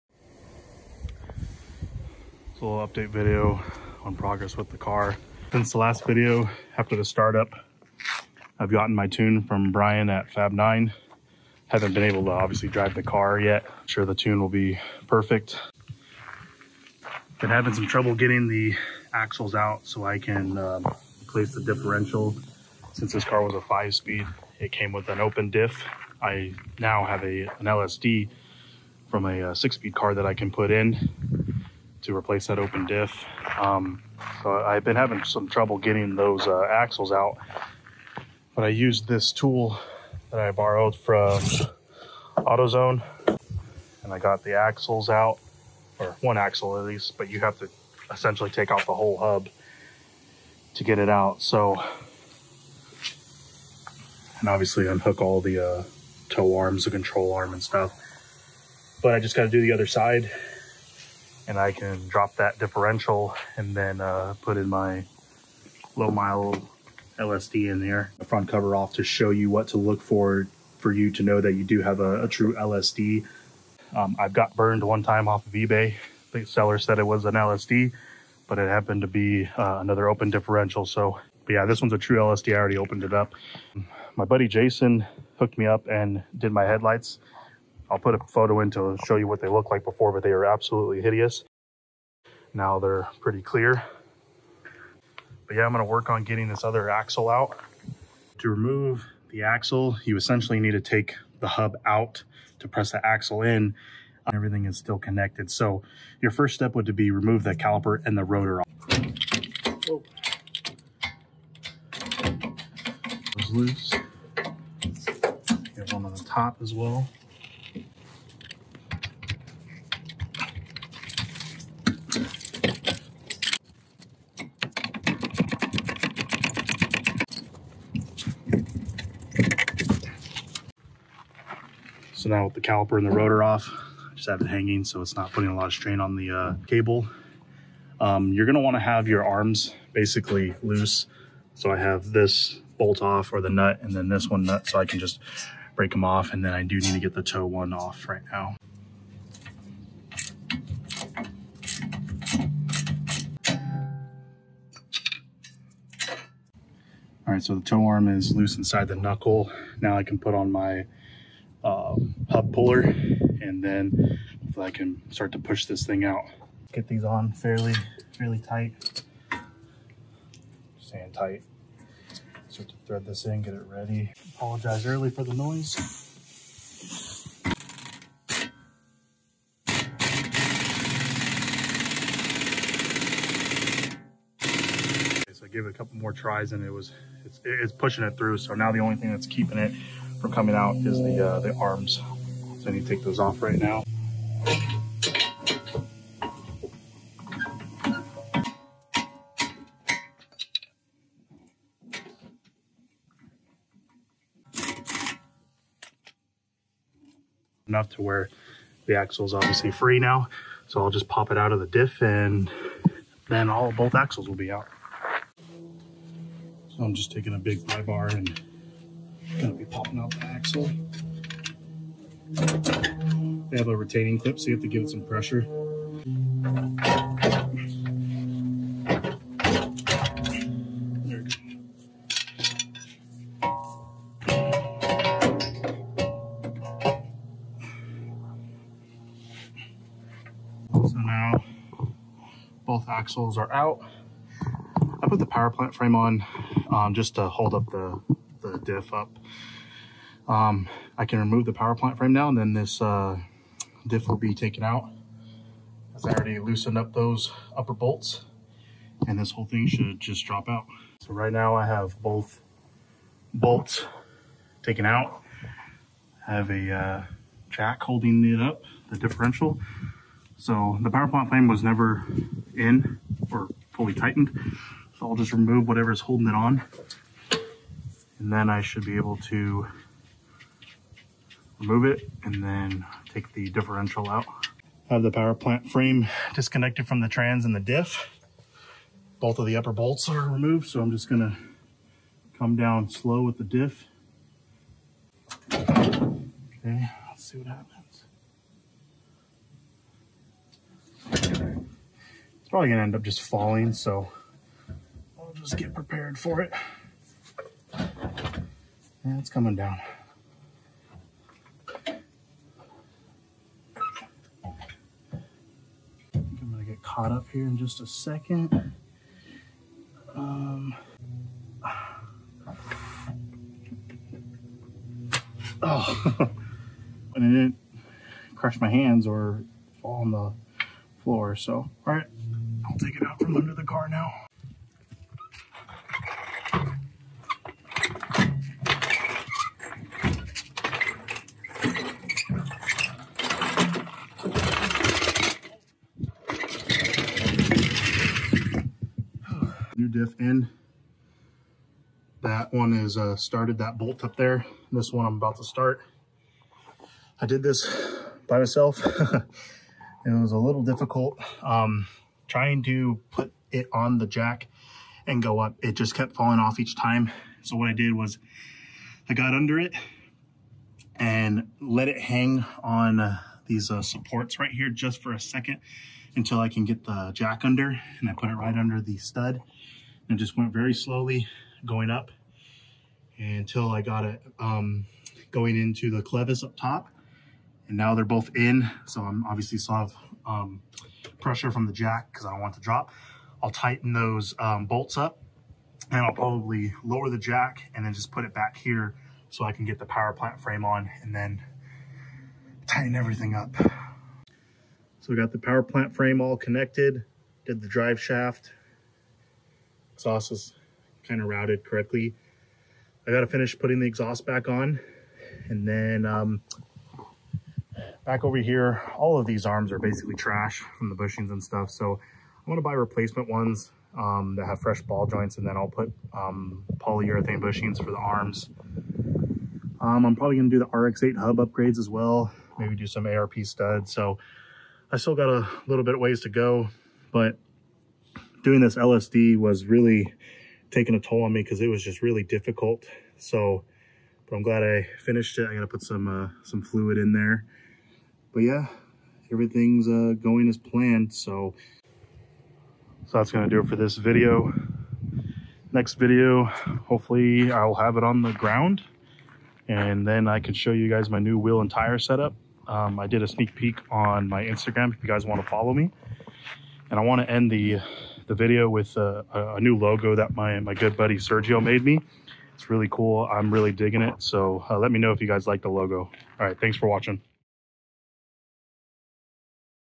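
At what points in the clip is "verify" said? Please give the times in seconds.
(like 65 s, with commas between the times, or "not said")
not said.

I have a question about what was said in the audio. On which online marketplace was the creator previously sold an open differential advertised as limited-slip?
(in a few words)
eBay.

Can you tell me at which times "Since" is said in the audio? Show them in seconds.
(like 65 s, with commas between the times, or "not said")
5 s, 22 s.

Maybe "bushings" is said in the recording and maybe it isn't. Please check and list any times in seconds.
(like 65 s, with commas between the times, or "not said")
420 s, 427 s.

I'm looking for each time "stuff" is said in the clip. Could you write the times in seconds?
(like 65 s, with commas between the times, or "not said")
57 s, 421 s.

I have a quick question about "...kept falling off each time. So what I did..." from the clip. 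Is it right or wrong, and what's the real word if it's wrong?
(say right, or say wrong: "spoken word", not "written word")
right.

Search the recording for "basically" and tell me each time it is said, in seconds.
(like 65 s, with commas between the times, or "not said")
139 s, 419 s.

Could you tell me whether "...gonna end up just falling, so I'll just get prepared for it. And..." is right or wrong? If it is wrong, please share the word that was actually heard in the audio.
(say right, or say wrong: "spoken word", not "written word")
right.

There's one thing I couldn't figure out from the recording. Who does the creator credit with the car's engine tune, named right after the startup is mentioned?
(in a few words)
Brian.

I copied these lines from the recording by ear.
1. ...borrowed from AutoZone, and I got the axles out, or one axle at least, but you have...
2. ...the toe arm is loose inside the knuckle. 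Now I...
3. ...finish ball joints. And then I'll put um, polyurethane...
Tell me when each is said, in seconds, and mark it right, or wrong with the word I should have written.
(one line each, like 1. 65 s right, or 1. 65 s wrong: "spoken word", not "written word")
1. 40 s right
2. 157 s right
3. 424 s wrong: "fresh", not "finish".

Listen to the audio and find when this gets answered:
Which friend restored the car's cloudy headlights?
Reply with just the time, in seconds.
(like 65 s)
84 s.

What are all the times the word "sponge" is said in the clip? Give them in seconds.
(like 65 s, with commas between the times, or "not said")
not said.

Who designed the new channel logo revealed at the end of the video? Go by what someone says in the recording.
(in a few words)
Sergio.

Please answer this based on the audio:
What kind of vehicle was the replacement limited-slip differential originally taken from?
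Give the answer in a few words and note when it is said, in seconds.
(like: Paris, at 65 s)
six speed car, at 29 s.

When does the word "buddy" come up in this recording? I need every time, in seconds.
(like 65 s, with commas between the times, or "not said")
84 s, 470 s.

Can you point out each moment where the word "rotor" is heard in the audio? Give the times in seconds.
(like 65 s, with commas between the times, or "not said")
108 s, 133 s.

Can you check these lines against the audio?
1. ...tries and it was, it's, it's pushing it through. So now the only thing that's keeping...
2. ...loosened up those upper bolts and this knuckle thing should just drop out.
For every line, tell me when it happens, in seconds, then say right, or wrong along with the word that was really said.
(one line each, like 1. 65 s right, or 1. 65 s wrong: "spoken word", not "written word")
1. 186 s right
2. 256 s wrong: "whole", not "knuckle".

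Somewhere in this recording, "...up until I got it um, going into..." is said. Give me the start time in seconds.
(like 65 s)
381 s.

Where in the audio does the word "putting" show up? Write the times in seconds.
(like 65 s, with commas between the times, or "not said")
135 s, 413 s.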